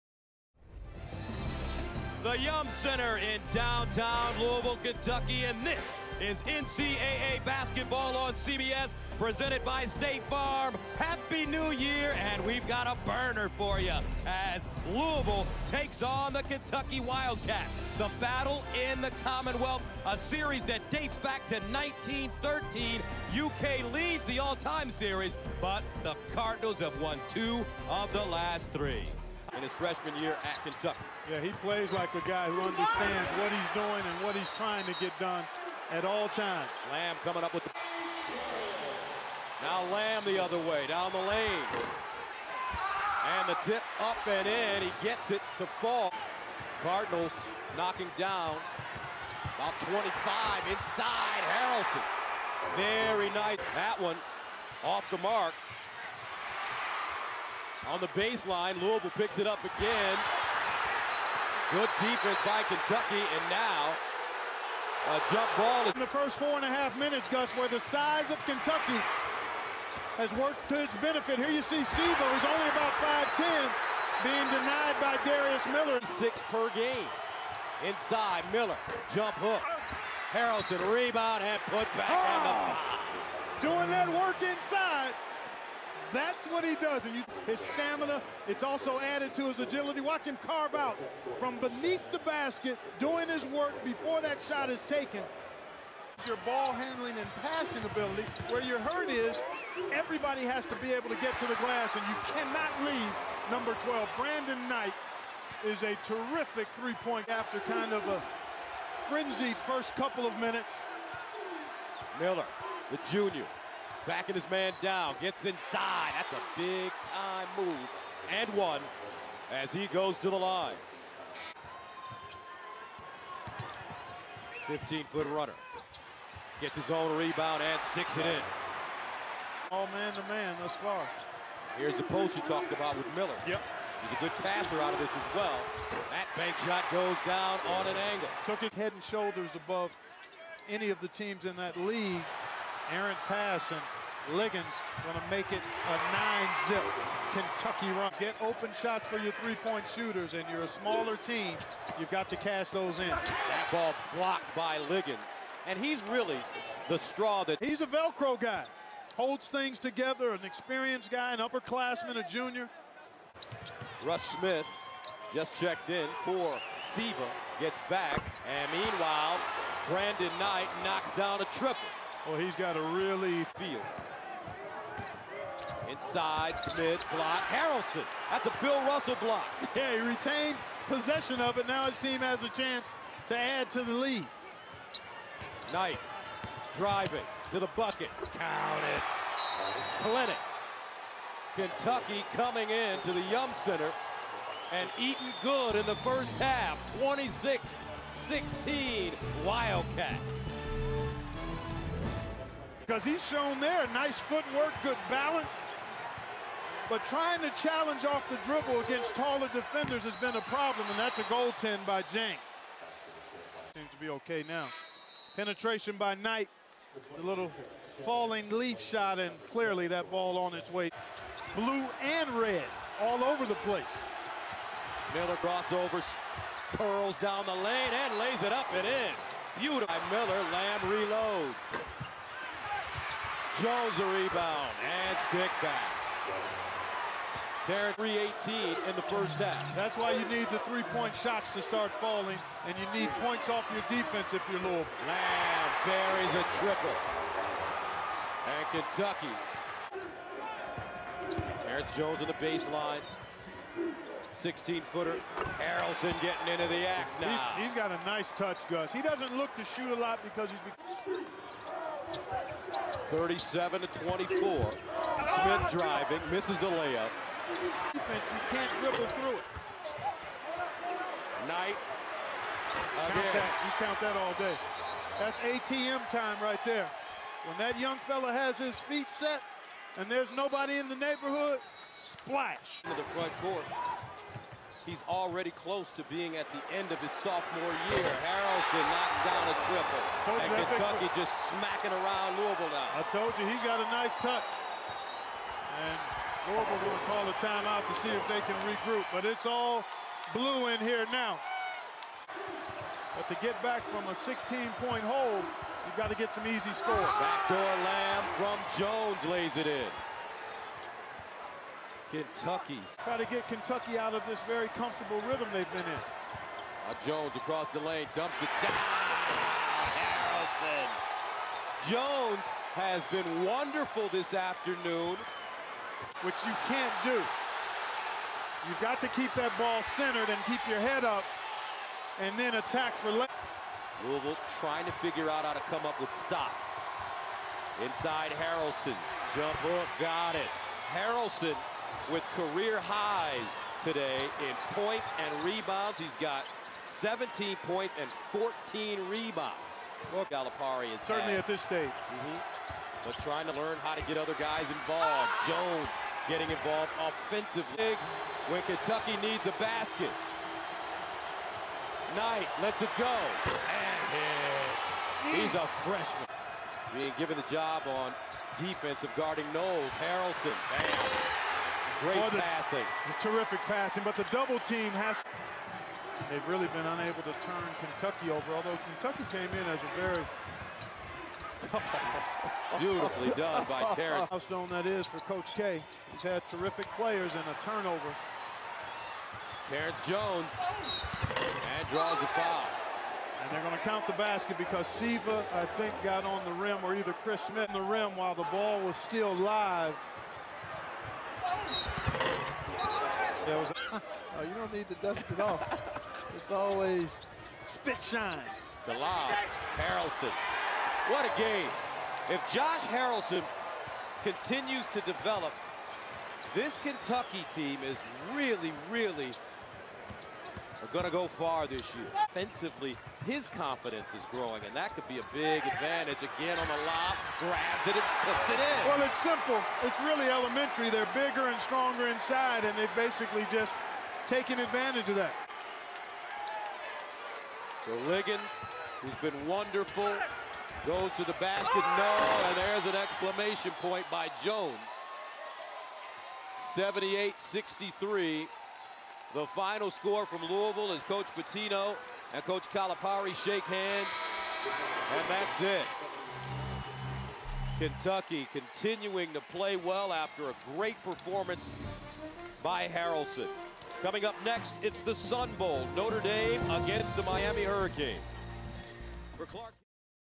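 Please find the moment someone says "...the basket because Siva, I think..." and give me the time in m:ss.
6:34.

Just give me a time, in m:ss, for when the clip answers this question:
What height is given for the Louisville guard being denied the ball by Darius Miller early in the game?
1:13.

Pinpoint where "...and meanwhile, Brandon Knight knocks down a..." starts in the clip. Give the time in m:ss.
2:48.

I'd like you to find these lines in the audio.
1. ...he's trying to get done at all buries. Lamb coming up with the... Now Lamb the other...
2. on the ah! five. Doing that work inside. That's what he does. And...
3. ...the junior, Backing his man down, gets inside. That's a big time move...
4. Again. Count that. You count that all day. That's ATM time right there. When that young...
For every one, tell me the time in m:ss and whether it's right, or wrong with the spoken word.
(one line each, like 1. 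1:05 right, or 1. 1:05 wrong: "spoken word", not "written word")
1. 0:34 wrong: "times", not "buries"
2. 1:22 right
3. 1:52 right
4. 4:33 right.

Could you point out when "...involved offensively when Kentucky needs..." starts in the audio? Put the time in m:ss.
5:56.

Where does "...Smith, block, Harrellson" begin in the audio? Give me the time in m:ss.
2:56.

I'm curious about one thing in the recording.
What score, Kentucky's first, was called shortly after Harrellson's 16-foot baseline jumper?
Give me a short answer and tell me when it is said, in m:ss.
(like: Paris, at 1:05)
37 to 24, at 4:23.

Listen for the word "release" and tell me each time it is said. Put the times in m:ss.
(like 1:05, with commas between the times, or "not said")
not said.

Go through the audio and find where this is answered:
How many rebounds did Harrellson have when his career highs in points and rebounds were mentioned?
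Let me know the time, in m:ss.
5:48.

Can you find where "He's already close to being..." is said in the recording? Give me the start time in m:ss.
4:44.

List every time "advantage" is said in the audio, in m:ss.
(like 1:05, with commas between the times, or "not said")
7:05, 7:14.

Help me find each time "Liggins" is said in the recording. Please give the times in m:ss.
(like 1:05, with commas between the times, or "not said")
2:24, 2:34, 7:18.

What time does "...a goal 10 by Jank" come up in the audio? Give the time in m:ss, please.
3:31.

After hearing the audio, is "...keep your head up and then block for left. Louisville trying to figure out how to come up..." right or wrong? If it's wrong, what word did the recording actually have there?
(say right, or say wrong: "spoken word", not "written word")
wrong: "attack", not "block".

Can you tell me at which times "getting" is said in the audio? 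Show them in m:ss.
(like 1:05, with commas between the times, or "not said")
4:16, 5:56.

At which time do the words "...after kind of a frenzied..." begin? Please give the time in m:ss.
1:47.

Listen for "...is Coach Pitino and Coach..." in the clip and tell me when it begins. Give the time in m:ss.
7:30.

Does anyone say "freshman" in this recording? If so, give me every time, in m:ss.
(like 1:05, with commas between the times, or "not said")
0:29, 6:05.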